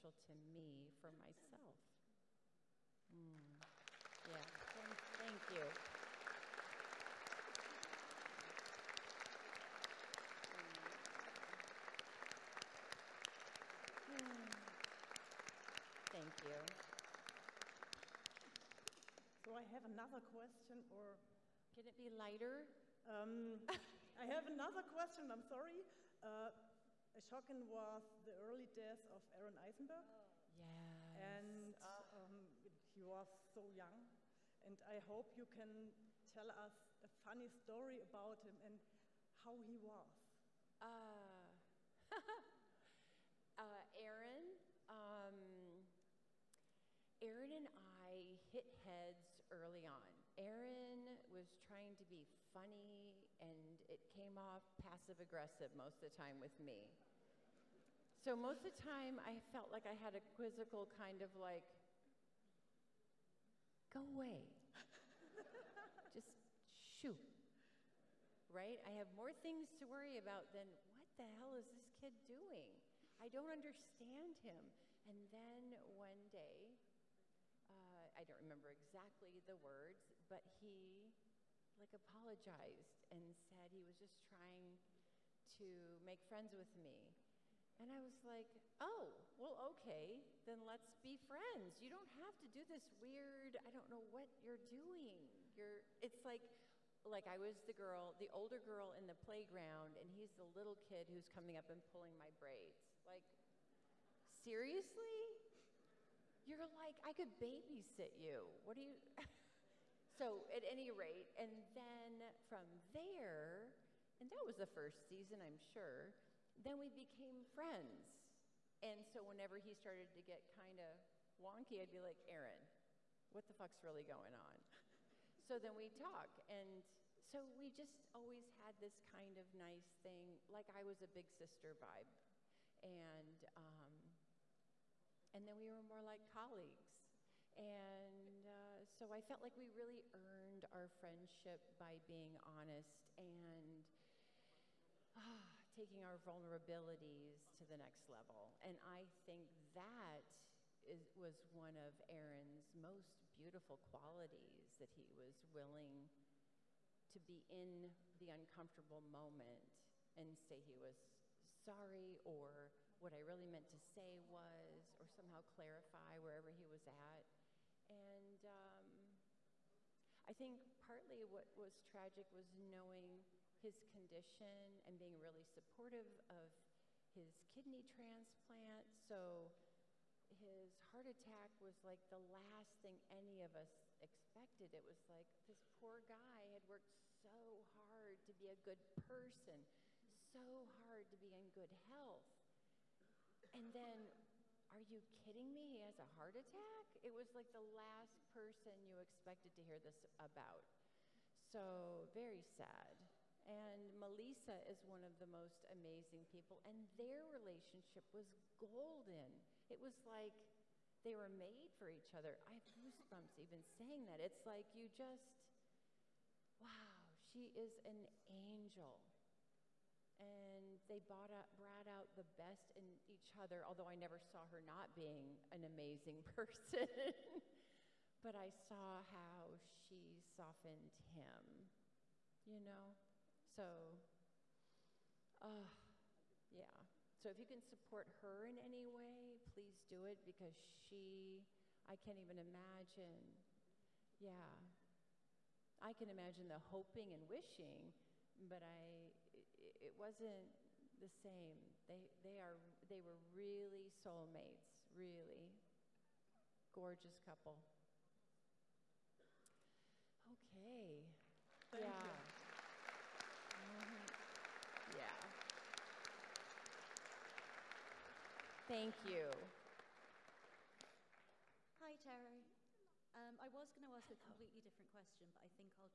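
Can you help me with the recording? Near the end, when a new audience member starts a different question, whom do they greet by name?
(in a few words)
Terry.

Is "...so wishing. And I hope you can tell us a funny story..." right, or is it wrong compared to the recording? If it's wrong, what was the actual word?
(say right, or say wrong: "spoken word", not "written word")
wrong: "young", not "wishing".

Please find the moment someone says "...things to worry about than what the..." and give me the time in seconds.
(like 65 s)
69 s.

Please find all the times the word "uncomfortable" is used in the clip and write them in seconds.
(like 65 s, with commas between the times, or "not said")
158 s.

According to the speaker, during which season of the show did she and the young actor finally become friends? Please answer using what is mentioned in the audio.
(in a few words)
first season.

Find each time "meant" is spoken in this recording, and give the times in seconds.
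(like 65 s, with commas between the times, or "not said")
163 s.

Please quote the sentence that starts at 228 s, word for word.
but I saw how she softened him, you know?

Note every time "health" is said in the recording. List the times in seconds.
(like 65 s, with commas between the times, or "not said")
191 s.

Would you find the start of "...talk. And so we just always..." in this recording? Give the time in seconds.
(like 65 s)
125 s.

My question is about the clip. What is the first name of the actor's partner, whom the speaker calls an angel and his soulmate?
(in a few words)
Melissa.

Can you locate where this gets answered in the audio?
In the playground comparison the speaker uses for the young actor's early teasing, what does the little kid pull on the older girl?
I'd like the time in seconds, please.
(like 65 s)
102 s.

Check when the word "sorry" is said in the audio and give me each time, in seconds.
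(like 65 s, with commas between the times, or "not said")
25 s, 161 s.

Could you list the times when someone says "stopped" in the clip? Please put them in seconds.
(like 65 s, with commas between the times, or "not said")
not said.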